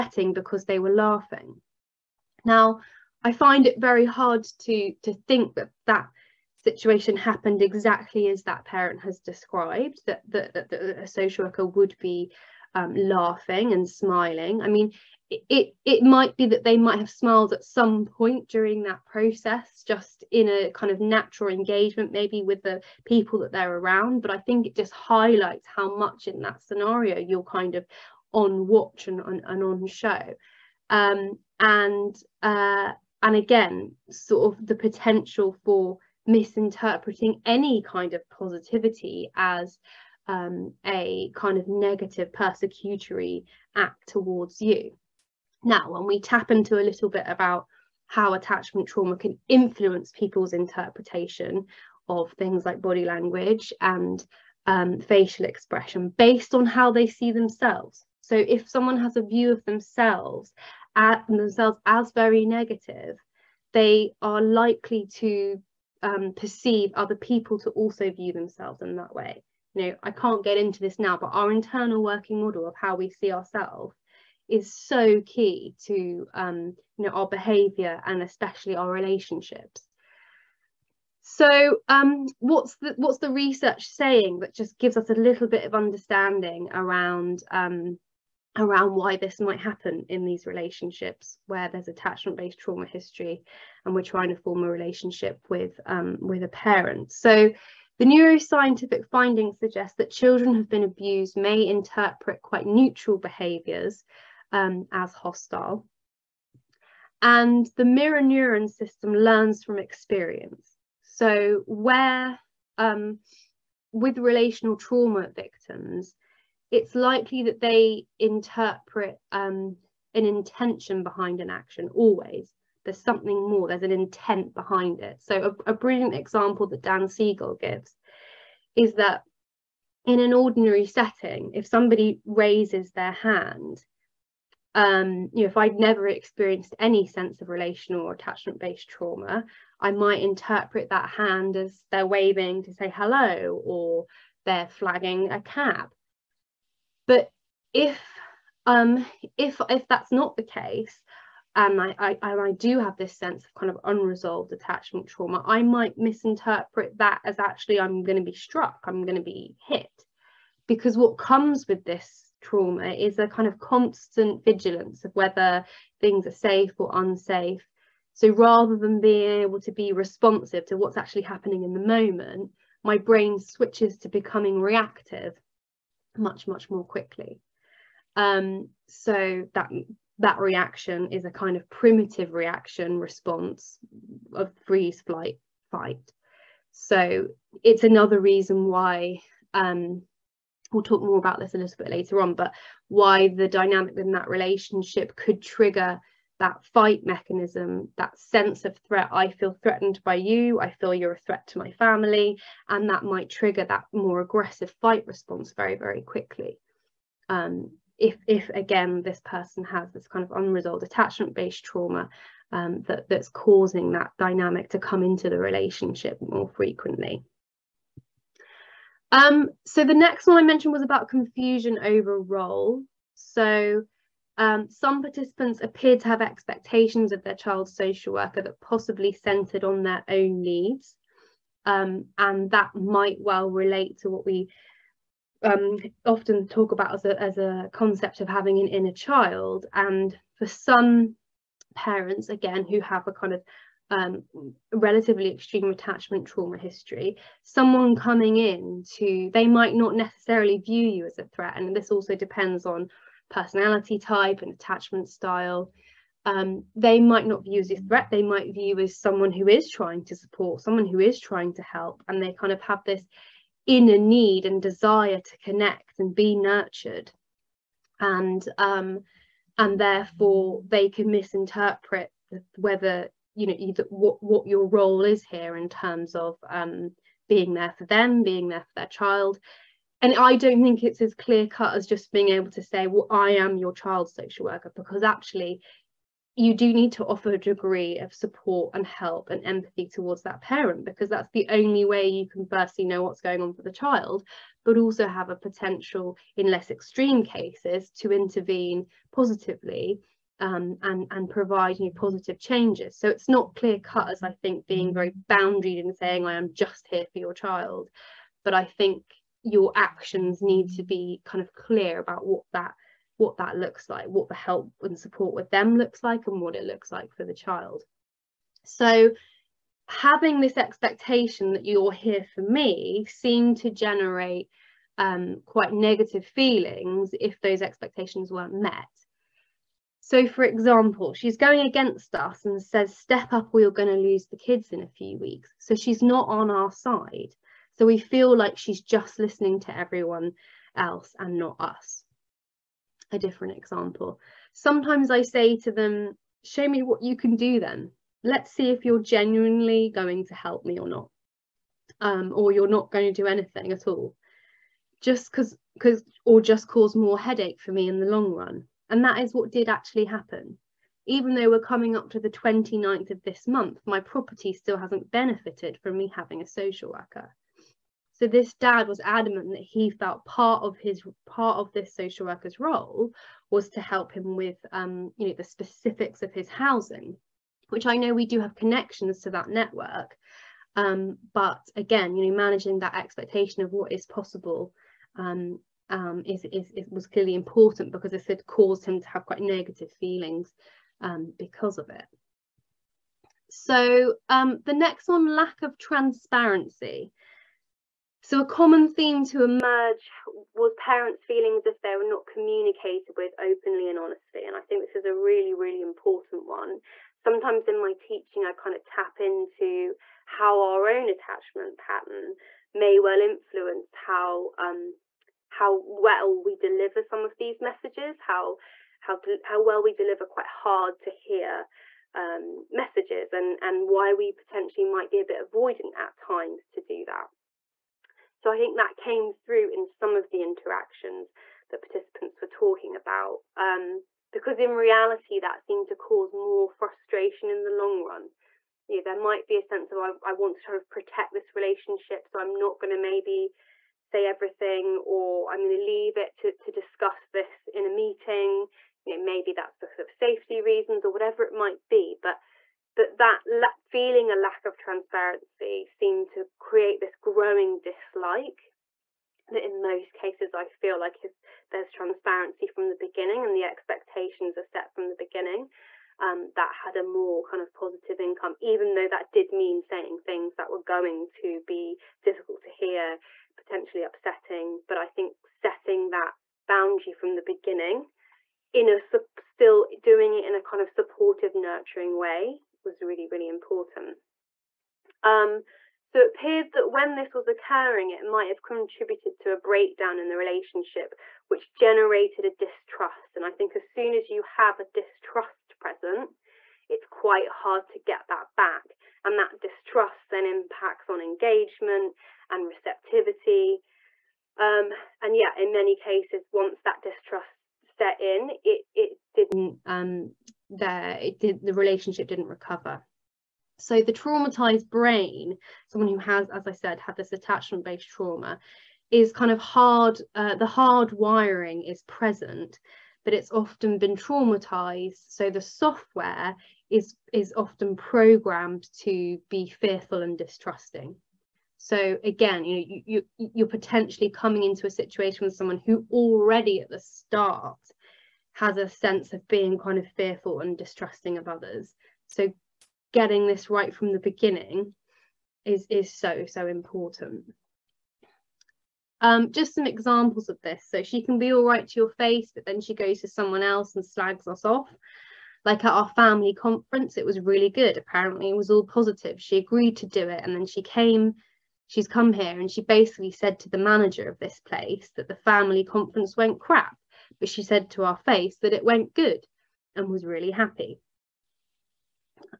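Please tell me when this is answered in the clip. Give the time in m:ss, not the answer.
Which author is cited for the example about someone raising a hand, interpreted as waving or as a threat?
2:06.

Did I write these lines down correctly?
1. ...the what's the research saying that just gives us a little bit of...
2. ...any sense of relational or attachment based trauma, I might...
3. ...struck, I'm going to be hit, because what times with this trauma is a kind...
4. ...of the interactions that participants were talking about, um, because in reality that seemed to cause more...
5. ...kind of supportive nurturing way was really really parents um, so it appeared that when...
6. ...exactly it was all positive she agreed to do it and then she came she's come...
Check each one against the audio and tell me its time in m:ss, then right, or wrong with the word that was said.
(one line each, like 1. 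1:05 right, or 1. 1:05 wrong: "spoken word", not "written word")
1. 1:22 right
2. 2:16 right
3. 2:38 wrong: "comes", not "times"
4. 7:10 right
5. 8:00 wrong: "important", not "parents"
6. 9:17 wrong: "apparently", not "exactly".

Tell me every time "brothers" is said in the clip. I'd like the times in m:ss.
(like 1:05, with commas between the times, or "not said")
not said.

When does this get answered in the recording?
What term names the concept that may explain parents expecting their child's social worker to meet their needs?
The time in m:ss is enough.
3:58.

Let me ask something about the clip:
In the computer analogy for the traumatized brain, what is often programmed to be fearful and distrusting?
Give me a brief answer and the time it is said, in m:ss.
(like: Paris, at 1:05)
the software, at 8:45.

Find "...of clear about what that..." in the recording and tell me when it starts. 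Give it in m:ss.
5:11.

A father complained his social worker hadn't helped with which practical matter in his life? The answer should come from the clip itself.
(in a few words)
housing.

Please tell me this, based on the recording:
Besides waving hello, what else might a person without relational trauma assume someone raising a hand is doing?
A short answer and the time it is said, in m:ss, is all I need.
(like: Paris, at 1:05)
flagging a cab, at 2:24.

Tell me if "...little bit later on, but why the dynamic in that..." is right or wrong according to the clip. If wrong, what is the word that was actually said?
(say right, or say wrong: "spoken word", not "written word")
right.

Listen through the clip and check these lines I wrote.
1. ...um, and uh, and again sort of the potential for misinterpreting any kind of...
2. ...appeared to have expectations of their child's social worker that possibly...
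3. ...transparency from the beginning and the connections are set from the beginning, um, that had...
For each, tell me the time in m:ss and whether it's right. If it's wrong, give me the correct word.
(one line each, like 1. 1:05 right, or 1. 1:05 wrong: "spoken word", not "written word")
1. 0:30 right
2. 3:45 right
3. 7:41 wrong: "expectations", not "connections".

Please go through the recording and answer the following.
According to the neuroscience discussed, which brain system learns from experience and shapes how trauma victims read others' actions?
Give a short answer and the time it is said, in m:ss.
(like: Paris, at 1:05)
mirror neuron system, at 1:47.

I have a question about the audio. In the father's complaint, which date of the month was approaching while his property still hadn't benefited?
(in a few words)
29th.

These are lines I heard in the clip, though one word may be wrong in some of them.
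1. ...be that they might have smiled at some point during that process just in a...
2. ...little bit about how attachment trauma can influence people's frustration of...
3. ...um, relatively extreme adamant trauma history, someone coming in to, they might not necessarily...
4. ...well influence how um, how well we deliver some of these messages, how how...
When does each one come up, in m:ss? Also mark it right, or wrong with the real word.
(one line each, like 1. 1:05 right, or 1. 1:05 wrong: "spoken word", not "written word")
1. 0:16 right
2. 0:46 wrong: "interpretation", not "frustration"
3. 4:03 wrong: "attachment", not "adamant"
4. 6:52 right.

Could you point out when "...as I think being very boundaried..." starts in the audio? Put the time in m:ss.
5:04.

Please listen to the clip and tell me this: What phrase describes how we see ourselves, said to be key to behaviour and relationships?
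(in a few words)
internal working model.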